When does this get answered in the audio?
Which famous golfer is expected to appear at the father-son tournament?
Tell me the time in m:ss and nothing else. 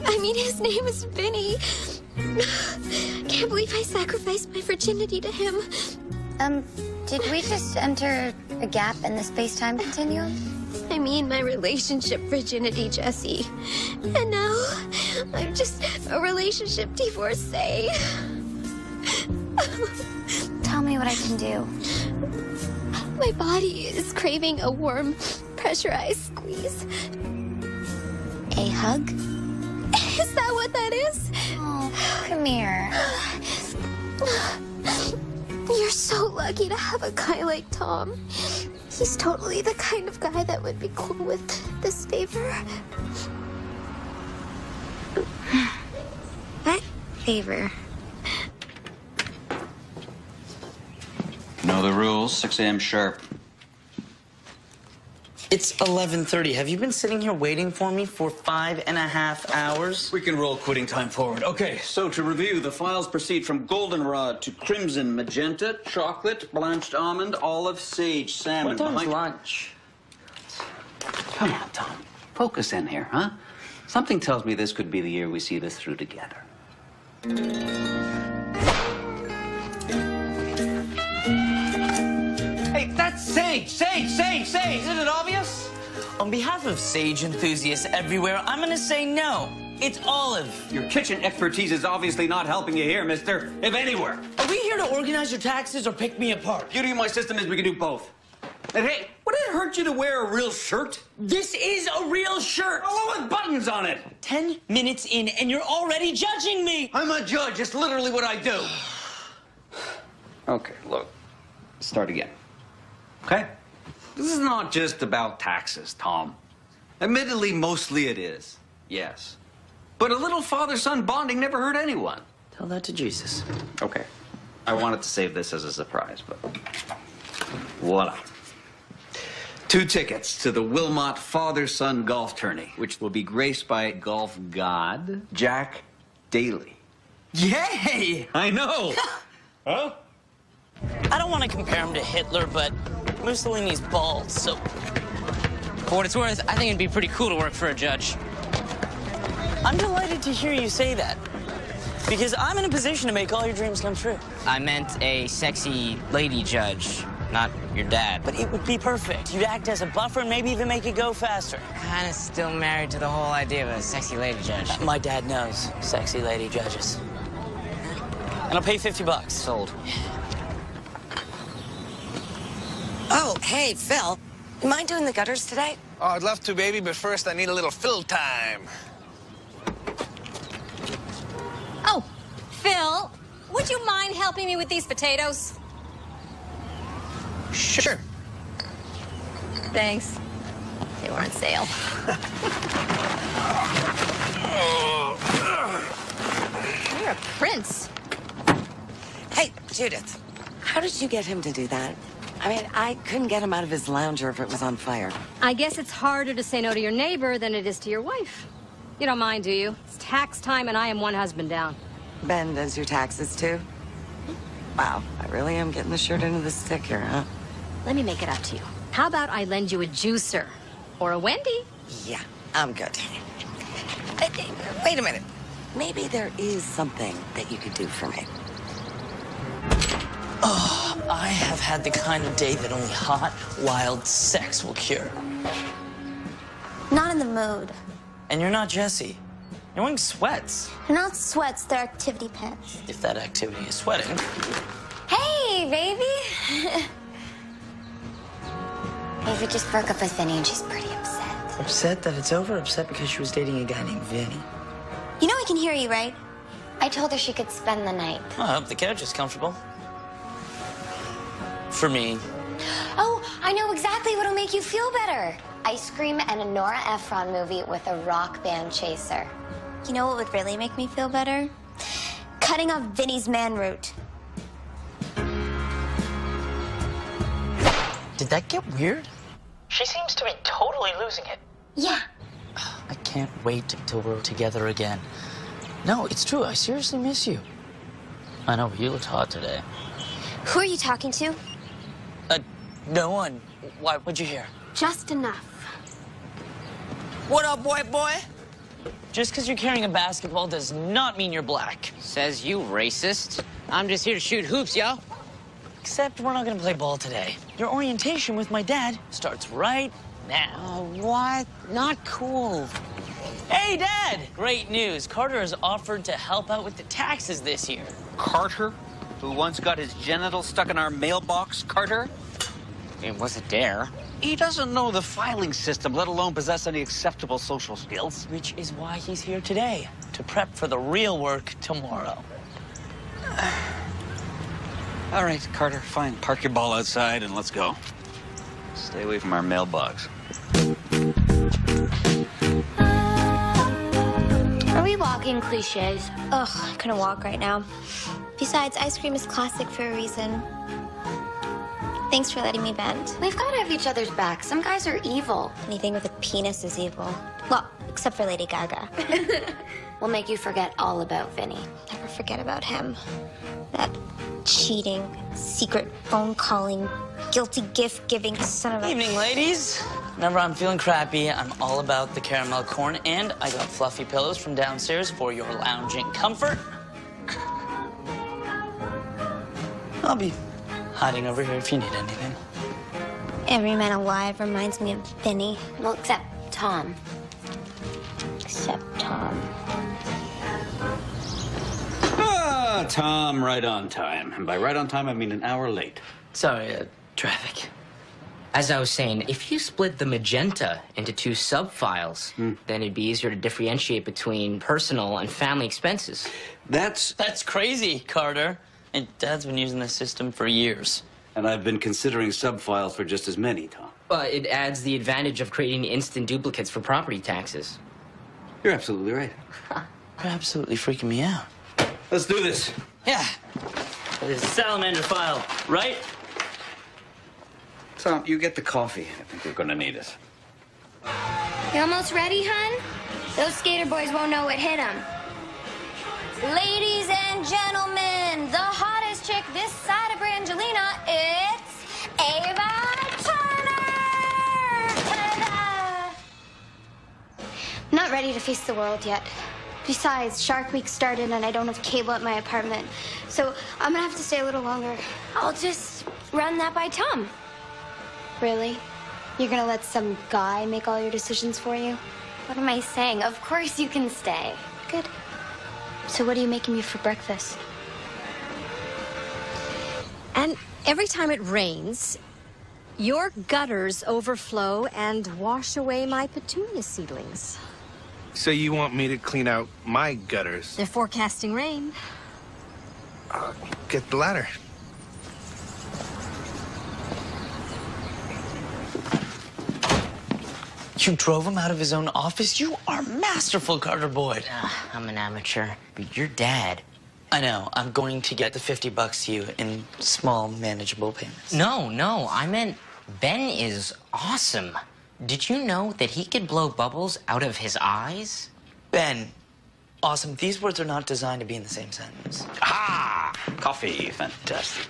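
2:15.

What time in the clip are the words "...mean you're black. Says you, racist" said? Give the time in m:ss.
5:01.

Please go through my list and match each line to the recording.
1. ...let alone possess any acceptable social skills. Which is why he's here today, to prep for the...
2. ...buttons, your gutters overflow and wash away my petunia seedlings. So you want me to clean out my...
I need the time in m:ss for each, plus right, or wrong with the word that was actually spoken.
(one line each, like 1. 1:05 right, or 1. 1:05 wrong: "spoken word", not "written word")
1. 5:25 right
2. 7:51 wrong: "rains", not "buttons".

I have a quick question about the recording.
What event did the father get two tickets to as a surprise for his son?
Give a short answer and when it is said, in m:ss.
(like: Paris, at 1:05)
Wilmot father son golf tourney, at 2:10.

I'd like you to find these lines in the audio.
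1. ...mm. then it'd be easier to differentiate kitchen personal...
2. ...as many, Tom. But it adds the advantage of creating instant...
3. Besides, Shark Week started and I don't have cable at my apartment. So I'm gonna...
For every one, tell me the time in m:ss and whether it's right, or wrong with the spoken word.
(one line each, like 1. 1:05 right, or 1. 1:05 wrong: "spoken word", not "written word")
1. 6:42 wrong: "between", not "kitchen"
2. 6:53 right
3. 7:29 right.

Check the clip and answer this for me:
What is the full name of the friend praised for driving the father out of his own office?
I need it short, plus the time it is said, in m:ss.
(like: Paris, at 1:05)
Carter Boyd, at 8:13.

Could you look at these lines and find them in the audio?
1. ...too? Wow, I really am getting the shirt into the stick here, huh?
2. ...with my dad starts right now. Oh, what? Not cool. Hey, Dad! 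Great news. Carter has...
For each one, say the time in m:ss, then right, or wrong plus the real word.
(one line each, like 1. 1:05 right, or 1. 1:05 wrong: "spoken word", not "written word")
1. 3:33 right
2. 5:08 right.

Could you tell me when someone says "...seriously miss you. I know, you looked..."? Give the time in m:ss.
4:46.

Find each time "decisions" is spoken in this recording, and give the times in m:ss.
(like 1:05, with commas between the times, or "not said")
7:41.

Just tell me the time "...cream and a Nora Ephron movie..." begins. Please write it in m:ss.
4:25.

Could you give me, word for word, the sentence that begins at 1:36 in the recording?
Beauty of my system is we can do both.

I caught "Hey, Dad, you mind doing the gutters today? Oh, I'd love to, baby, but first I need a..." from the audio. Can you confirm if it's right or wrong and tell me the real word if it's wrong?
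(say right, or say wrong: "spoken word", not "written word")
wrong: "Phil", not "Dad".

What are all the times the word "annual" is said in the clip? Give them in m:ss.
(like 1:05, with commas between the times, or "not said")
not said.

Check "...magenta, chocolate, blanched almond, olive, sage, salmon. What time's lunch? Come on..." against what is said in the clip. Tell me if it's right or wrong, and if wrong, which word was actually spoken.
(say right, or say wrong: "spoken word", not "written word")
right.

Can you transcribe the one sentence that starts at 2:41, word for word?
Kinda still married to the whole idea of a sexy lady judge.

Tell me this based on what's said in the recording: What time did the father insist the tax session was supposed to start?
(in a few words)
6 a.m.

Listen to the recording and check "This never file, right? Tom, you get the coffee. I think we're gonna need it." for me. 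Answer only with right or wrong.
wrong.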